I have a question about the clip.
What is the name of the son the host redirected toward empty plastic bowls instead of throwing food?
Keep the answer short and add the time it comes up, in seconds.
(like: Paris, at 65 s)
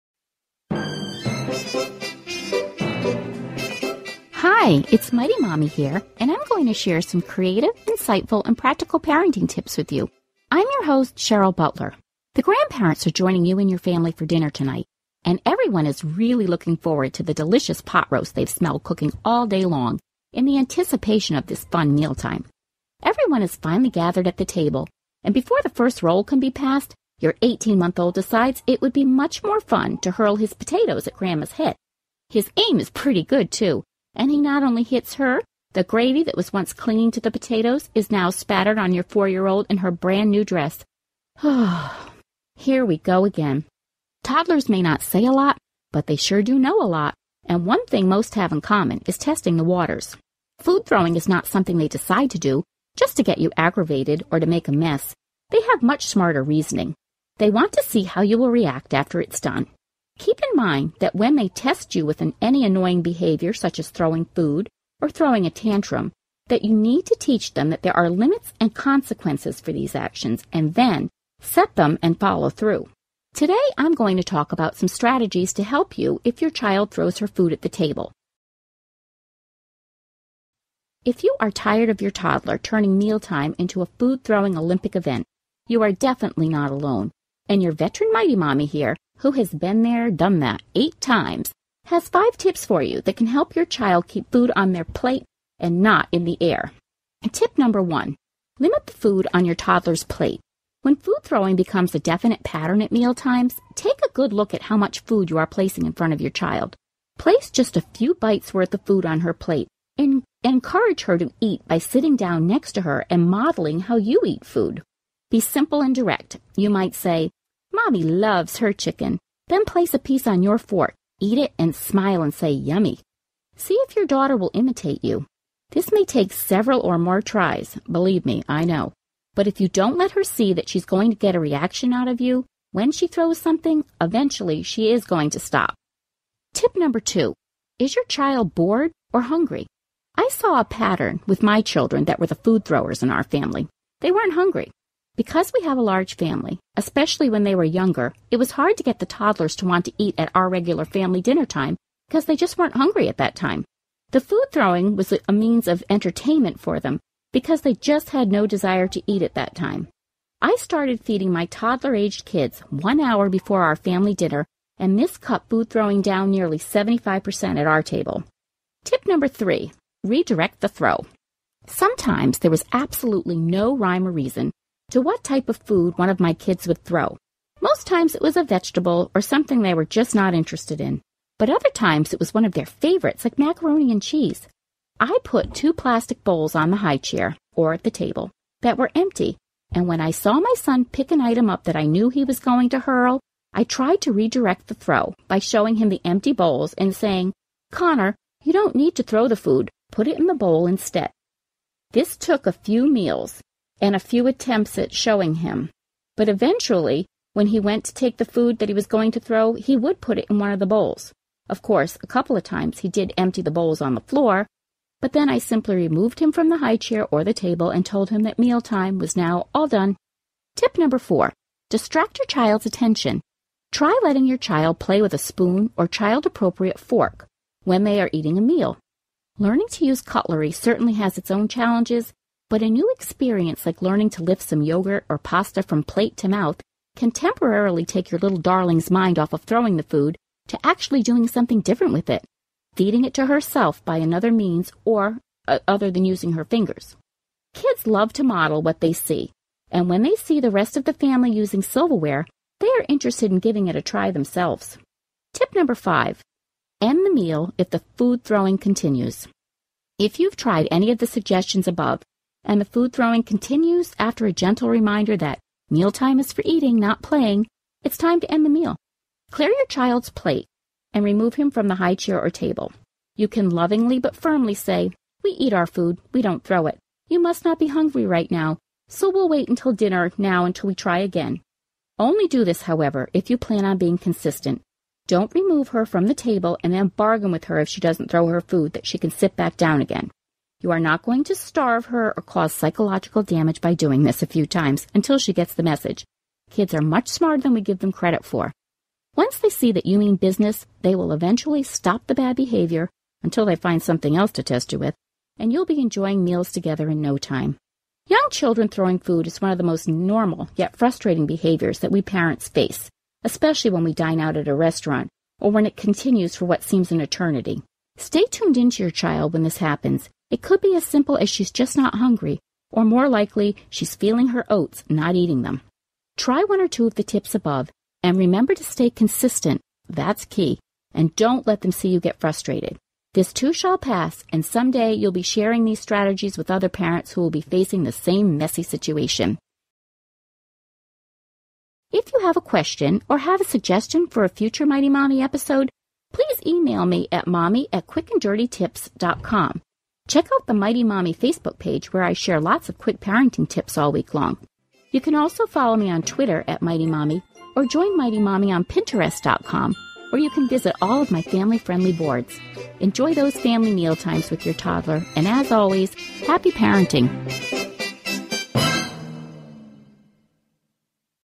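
Connor, at 197 s.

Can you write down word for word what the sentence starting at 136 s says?
Tip number two Is your child bored or hungry?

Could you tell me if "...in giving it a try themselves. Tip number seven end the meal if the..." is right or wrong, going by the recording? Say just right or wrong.
wrong.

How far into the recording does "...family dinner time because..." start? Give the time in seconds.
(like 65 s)
150 s.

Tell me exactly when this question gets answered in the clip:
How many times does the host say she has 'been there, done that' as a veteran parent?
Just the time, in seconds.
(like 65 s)
90 s.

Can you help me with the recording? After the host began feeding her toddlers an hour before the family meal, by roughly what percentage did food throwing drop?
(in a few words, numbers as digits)
75%.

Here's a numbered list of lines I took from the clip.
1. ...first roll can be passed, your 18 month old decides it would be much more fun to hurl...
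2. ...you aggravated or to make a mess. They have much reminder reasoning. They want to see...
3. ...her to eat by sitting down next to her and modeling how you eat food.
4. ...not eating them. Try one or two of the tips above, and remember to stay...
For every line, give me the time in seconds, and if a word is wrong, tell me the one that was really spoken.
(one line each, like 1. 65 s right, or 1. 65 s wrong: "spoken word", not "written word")
1. 25 s right
2. 53 s wrong: "smarter", not "reminder"
3. 111 s right
4. 324 s right.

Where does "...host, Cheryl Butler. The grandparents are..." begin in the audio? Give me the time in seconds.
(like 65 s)
10 s.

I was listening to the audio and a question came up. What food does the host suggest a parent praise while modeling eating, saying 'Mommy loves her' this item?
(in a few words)
chicken.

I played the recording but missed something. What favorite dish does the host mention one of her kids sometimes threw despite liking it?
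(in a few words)
macaroni and cheese.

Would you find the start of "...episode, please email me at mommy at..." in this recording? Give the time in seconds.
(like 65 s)
345 s.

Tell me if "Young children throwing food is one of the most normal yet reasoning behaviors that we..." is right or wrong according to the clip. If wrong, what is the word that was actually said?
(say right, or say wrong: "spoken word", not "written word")
wrong: "frustrating", not "reasoning".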